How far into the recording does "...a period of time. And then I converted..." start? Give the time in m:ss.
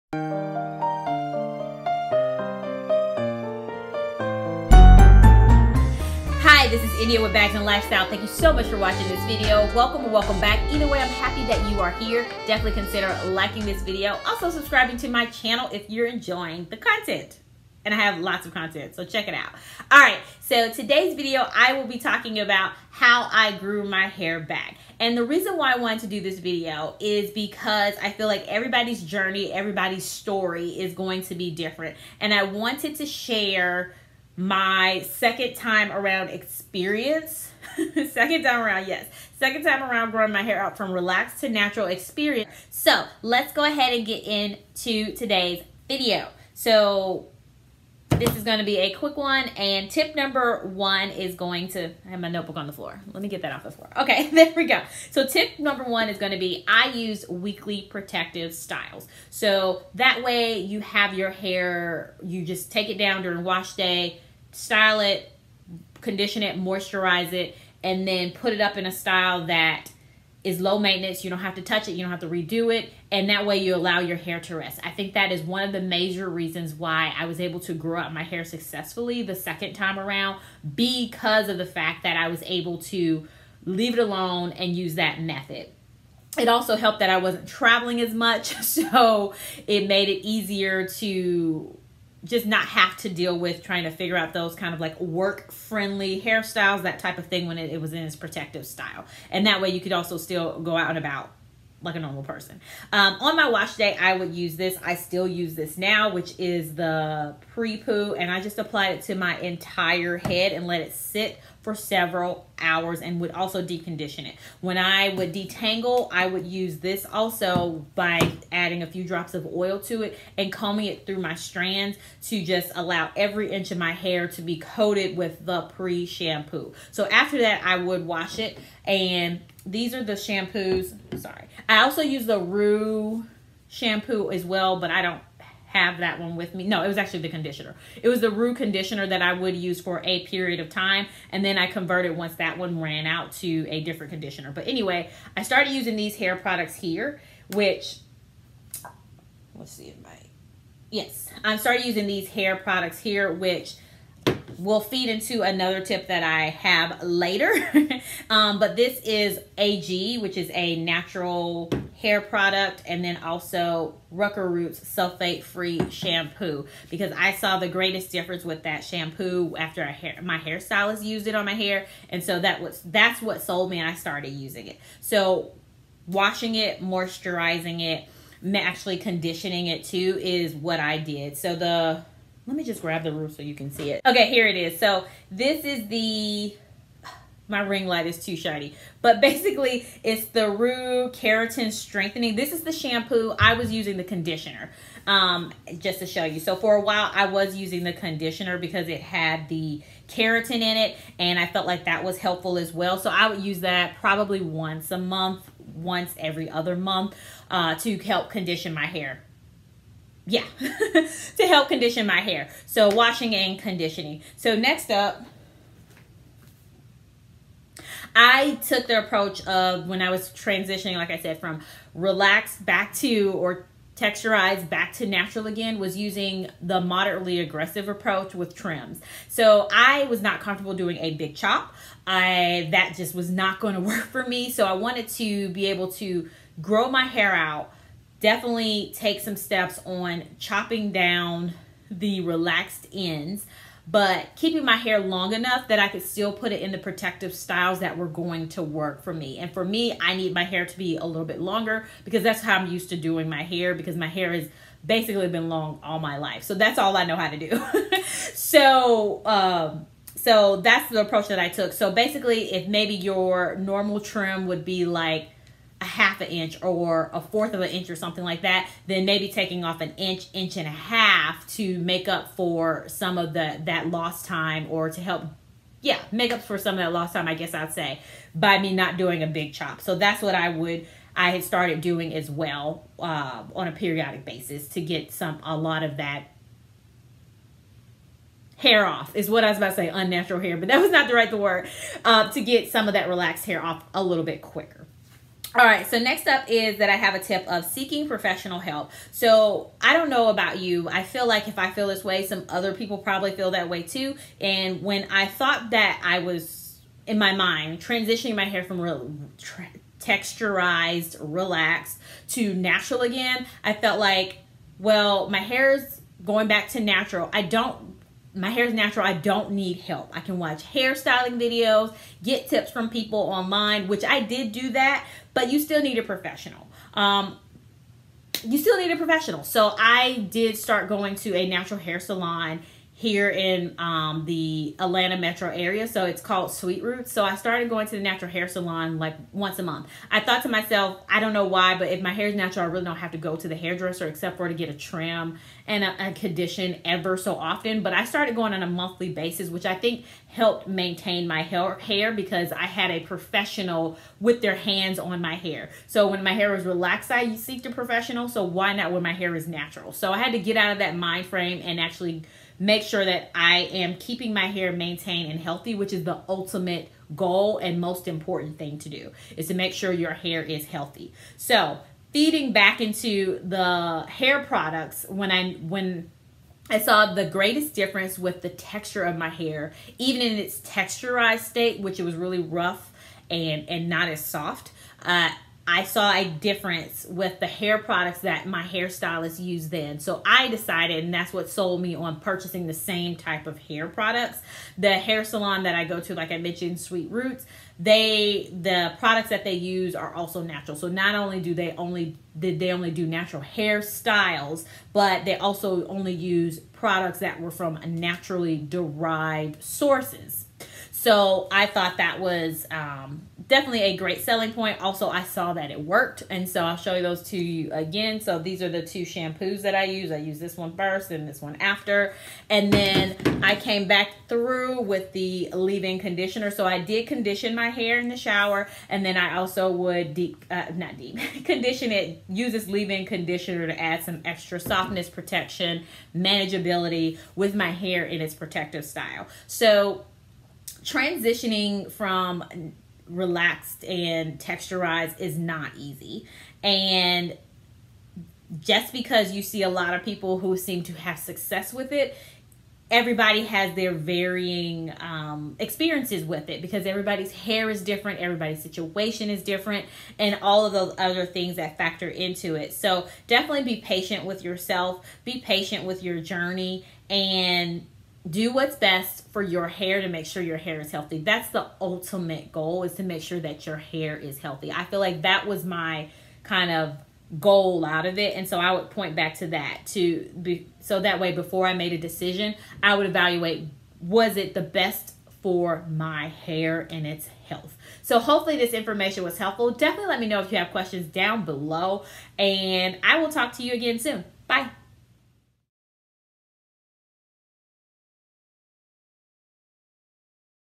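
2:20.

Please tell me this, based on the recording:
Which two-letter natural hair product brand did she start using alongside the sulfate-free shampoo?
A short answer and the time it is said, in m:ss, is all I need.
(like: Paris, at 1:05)
AG, at 2:39.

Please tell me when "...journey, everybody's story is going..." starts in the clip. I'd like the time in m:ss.
0:29.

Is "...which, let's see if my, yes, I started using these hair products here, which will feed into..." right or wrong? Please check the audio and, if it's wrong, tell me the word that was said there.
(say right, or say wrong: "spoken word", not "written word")
right.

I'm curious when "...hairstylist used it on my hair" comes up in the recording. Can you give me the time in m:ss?
2:50.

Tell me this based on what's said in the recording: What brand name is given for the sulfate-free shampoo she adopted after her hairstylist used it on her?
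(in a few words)
Rucker Roots.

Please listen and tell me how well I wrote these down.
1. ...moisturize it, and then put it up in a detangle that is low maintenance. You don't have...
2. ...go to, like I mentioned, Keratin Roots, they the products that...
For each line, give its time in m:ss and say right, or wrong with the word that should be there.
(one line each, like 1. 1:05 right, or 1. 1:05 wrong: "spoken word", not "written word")
1. 1:06 wrong: "style", not "detangle"
2. 6:35 wrong: "Sweet", not "Keratin".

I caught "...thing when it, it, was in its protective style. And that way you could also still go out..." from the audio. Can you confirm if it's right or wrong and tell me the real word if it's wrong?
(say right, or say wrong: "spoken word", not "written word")
right.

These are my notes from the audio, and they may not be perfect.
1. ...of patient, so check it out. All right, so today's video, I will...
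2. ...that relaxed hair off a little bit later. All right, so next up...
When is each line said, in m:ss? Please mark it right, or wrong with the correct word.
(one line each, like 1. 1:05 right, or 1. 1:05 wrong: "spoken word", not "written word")
1. 0:18 wrong: "content", not "patient"
2. 4:52 wrong: "quicker", not "later".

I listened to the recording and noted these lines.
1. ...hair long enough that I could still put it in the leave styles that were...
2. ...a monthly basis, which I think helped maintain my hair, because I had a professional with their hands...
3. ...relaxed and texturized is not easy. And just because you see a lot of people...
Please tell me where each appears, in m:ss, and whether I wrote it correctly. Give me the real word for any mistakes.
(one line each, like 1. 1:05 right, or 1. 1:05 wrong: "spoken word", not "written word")
1. 4:04 wrong: "protective", not "leave"
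2. 5:48 right
3. 7:23 right.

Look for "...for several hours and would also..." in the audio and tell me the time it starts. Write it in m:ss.
1:51.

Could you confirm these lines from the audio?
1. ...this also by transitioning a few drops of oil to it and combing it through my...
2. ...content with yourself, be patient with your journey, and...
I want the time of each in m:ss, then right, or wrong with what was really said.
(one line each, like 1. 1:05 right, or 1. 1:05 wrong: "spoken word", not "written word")
1. 1:56 wrong: "adding", not "transitioning"
2. 7:43 wrong: "patient", not "content".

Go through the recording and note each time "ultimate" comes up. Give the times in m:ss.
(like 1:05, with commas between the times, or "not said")
6:06, 7:51.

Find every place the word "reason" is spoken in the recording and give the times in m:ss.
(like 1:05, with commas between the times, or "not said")
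0:25, 1:16.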